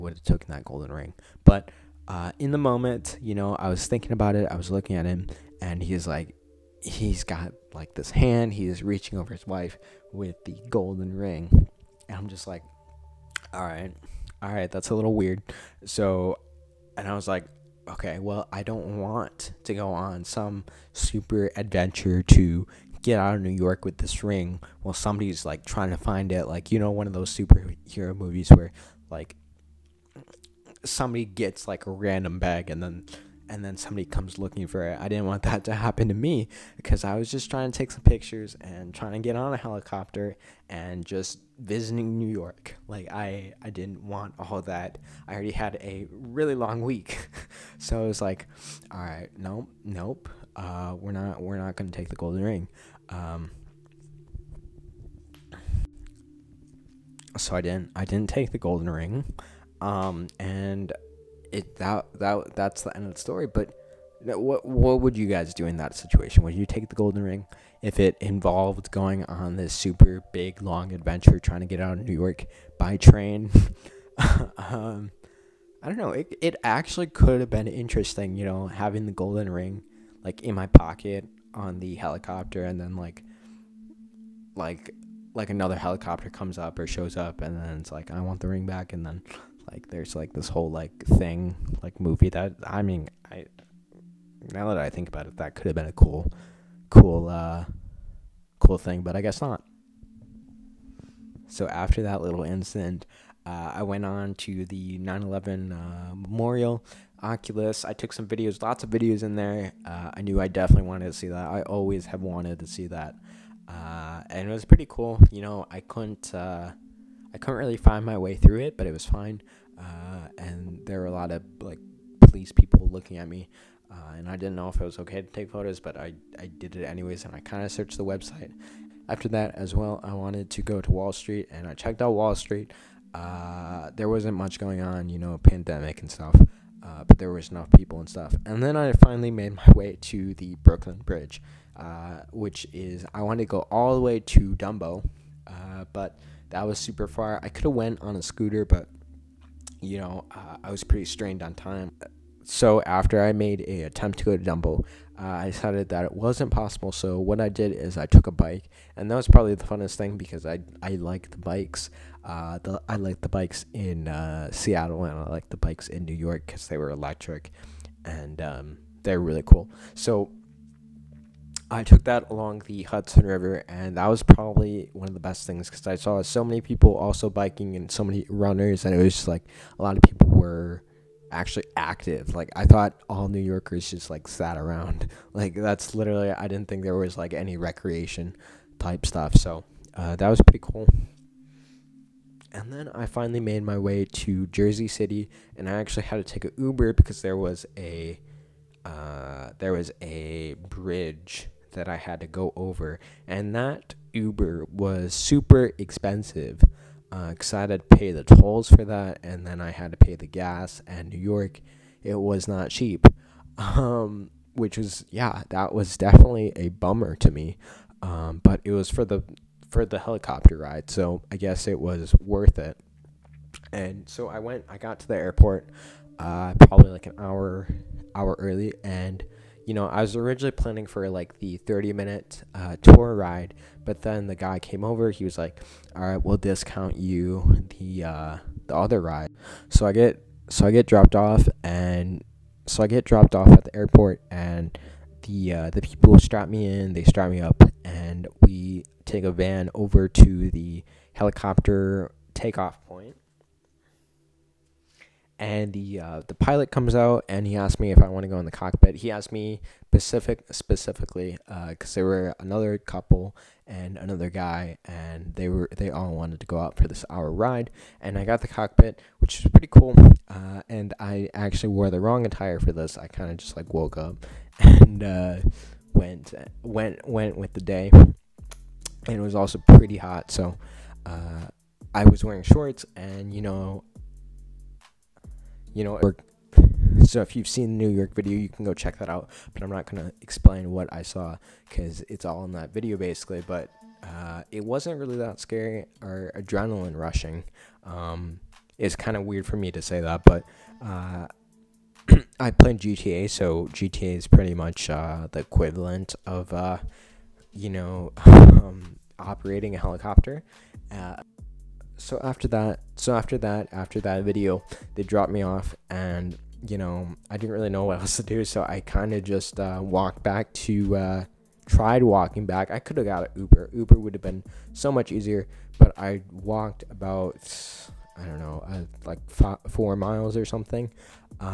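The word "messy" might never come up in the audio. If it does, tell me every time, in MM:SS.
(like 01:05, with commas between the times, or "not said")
not said.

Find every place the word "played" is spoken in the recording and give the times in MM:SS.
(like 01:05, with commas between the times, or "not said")
05:02.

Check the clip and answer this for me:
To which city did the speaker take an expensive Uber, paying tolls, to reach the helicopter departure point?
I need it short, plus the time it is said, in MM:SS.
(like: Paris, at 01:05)
Jersey City, at 03:14.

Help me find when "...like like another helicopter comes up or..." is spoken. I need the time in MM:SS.
01:24.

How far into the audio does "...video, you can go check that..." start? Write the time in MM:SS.
04:48.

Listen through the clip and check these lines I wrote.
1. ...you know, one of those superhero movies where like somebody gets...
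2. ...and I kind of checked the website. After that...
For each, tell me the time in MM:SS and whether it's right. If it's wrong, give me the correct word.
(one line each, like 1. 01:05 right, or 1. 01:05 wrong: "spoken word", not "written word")
1. 00:26 right
2. 02:07 wrong: "searched", not "checked".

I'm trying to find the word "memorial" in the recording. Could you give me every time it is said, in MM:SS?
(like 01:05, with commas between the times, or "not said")
01:46.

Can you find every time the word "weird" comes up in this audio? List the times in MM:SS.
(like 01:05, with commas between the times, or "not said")
00:15, 04:59.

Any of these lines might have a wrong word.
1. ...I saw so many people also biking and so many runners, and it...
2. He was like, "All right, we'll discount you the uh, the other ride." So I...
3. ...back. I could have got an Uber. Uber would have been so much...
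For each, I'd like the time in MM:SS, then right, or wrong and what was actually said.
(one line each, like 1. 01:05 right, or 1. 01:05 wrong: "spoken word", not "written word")
1. 02:55 right
2. 03:55 right
3. 05:22 right.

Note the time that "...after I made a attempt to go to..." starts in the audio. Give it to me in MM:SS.
02:32.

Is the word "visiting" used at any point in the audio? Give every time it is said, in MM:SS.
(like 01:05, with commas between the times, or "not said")
00:41.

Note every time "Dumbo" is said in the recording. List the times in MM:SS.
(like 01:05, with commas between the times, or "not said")
02:24, 02:34.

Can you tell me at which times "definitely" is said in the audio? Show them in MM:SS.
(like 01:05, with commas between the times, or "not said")
01:50, 03:35.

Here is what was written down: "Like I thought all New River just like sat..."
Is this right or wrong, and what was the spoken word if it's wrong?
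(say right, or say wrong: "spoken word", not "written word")
wrong: "Yorkers", not "River".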